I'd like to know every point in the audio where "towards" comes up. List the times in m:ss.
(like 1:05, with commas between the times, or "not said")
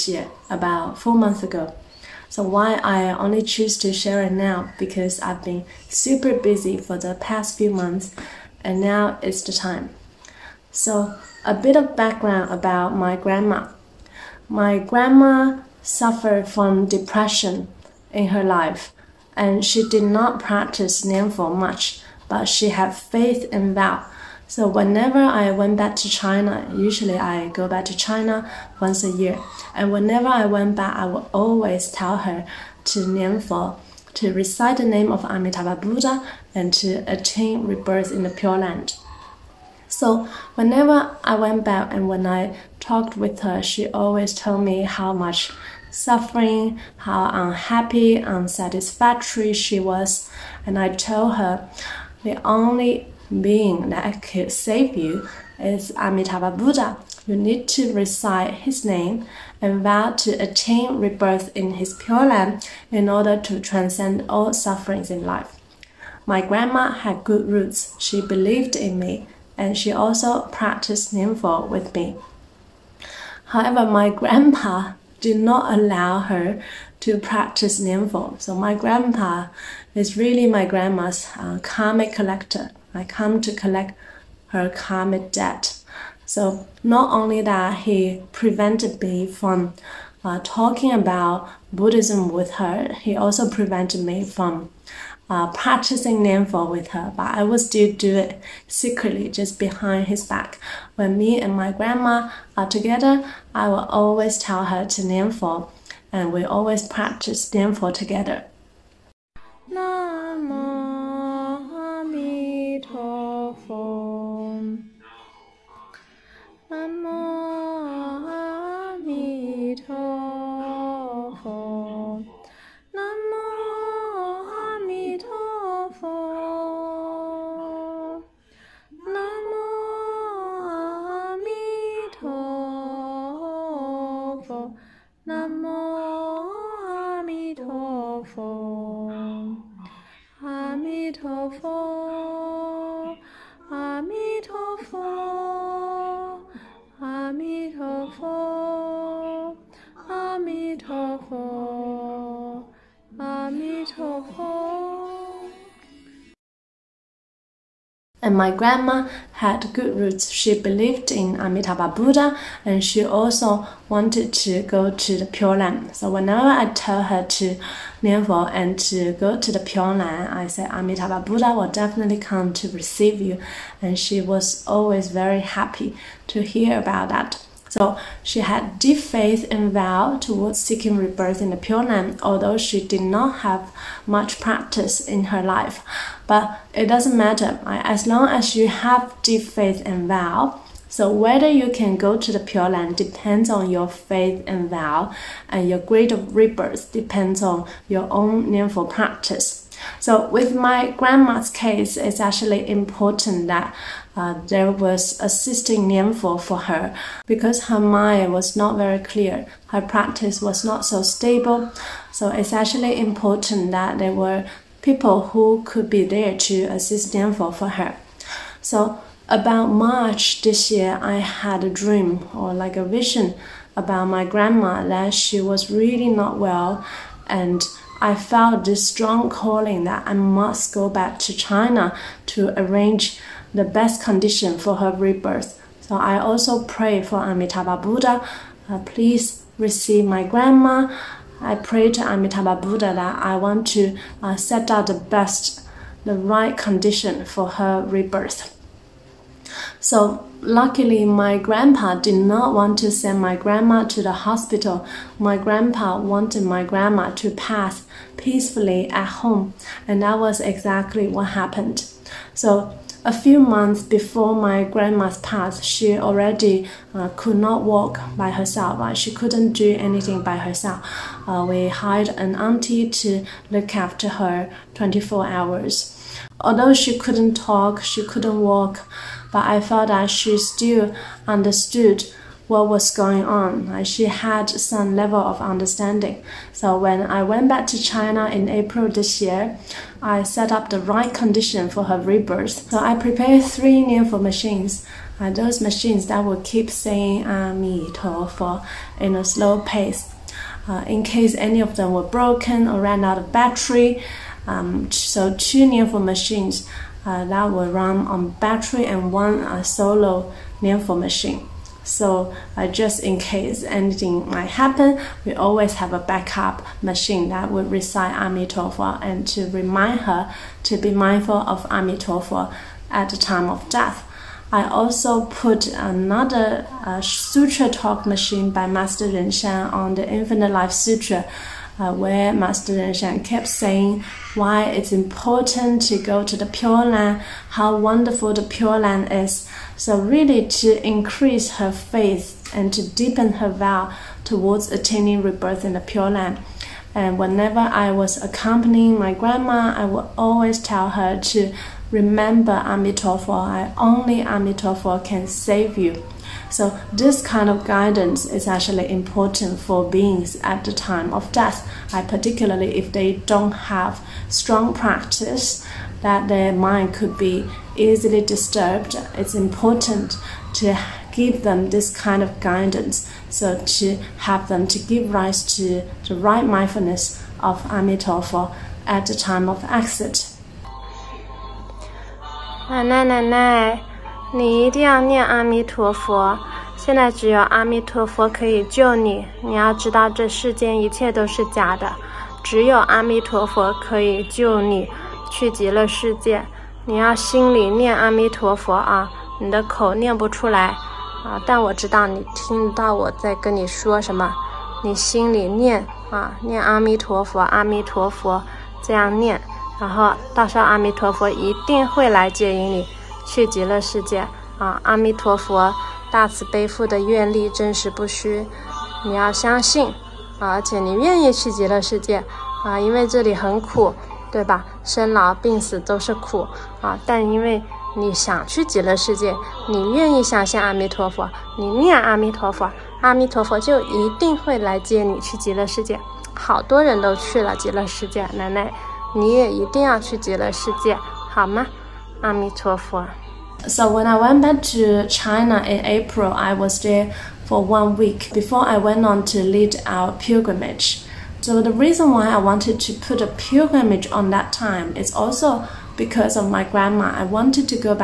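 3:00, 5:44.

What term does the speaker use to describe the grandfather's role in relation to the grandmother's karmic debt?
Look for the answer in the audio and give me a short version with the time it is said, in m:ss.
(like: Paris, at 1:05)
karmic collector, at 1:21.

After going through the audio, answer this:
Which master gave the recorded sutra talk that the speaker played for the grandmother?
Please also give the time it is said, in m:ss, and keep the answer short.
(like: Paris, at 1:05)
Master Ren Shan, at 5:28.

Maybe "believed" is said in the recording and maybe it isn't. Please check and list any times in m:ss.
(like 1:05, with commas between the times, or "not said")
1:08, 2:40.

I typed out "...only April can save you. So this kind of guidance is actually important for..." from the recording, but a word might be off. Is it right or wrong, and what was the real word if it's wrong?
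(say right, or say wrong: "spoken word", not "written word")
wrong: "Amitofo", not "April".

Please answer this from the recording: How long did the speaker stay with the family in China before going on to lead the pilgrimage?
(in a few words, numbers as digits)
1 week.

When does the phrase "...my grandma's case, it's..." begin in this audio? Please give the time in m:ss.
3:20.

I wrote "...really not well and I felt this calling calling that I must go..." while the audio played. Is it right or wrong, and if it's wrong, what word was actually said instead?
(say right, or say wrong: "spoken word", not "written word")
wrong: "strong", not "calling".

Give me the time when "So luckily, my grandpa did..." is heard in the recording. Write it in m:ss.
4:09.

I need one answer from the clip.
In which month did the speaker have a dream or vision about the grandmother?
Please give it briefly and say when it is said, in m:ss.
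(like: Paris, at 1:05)
March, at 3:39.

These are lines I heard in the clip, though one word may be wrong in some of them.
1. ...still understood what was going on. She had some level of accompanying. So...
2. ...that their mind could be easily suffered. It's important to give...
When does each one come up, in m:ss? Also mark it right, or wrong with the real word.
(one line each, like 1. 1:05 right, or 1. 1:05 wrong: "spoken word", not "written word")
1. 4:40 wrong: "understanding", not "accompanying"
2. 6:06 wrong: "disturbed", not "suffered".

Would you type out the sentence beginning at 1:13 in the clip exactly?
However, my grandpa did not allow her to practice Nianfo.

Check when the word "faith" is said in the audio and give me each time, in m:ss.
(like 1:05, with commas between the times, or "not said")
0:22, 2:58, 3:09, 3:13, 5:41.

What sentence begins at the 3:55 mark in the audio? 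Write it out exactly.
So I also pray for Amitabha Buddha, uh, please receive my grandma.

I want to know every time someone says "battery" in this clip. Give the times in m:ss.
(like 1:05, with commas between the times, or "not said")
5:03, 5:08.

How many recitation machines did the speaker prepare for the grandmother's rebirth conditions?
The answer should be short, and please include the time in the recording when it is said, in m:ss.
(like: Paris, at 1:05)
3, at 4:53.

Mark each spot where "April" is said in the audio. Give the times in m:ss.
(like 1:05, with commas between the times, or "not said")
4:48, 7:25.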